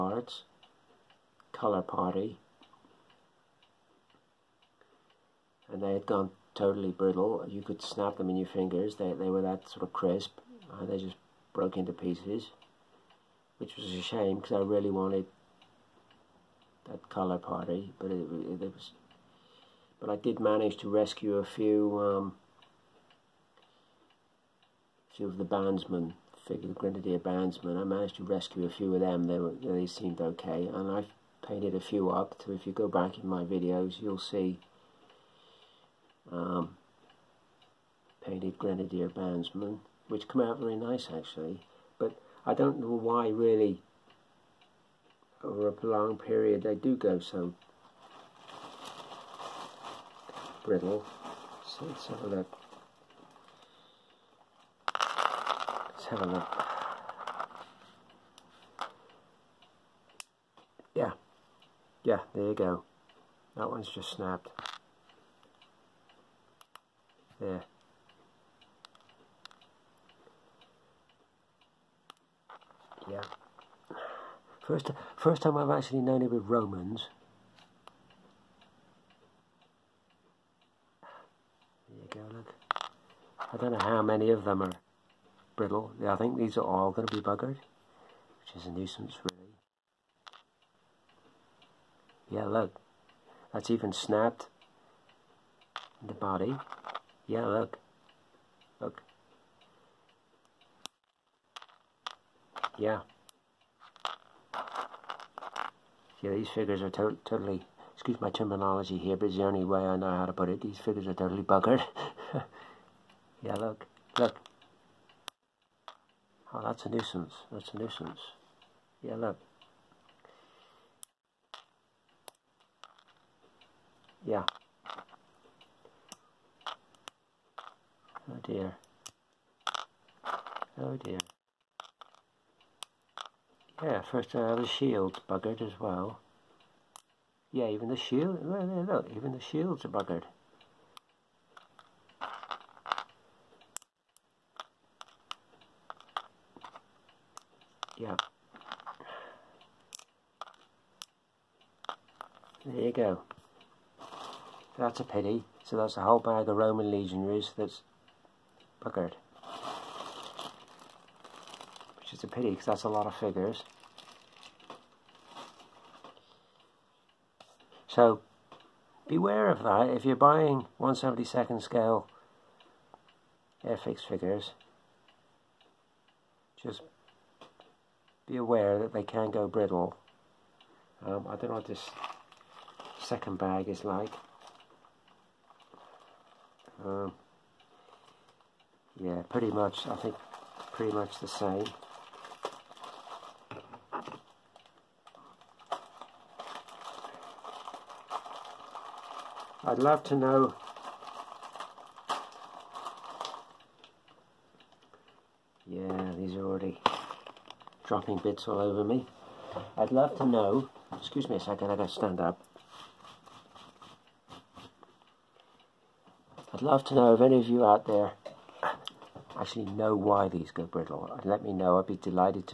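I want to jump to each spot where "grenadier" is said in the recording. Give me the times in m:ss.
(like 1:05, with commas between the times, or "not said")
0:26, 0:38.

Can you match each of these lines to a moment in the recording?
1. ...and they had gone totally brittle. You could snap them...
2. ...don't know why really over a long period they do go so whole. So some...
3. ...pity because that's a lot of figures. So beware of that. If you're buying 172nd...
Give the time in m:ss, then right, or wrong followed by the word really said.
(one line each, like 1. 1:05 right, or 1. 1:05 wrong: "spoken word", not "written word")
1. 0:05 right
2. 0:42 wrong: "brittle", not "whole"
3. 2:42 right.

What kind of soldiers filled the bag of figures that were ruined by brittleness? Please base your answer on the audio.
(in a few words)
Roman legionaries.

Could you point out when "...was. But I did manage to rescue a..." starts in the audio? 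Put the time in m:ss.
0:18.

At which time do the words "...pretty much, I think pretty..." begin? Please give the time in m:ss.
3:09.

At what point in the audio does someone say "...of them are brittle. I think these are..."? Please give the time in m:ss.
1:24.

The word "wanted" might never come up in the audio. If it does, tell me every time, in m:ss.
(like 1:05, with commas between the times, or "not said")
0:14.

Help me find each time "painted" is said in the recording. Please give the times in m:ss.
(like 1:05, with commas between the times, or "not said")
0:31, 0:38.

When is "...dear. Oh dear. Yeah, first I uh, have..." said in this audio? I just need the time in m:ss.
2:08.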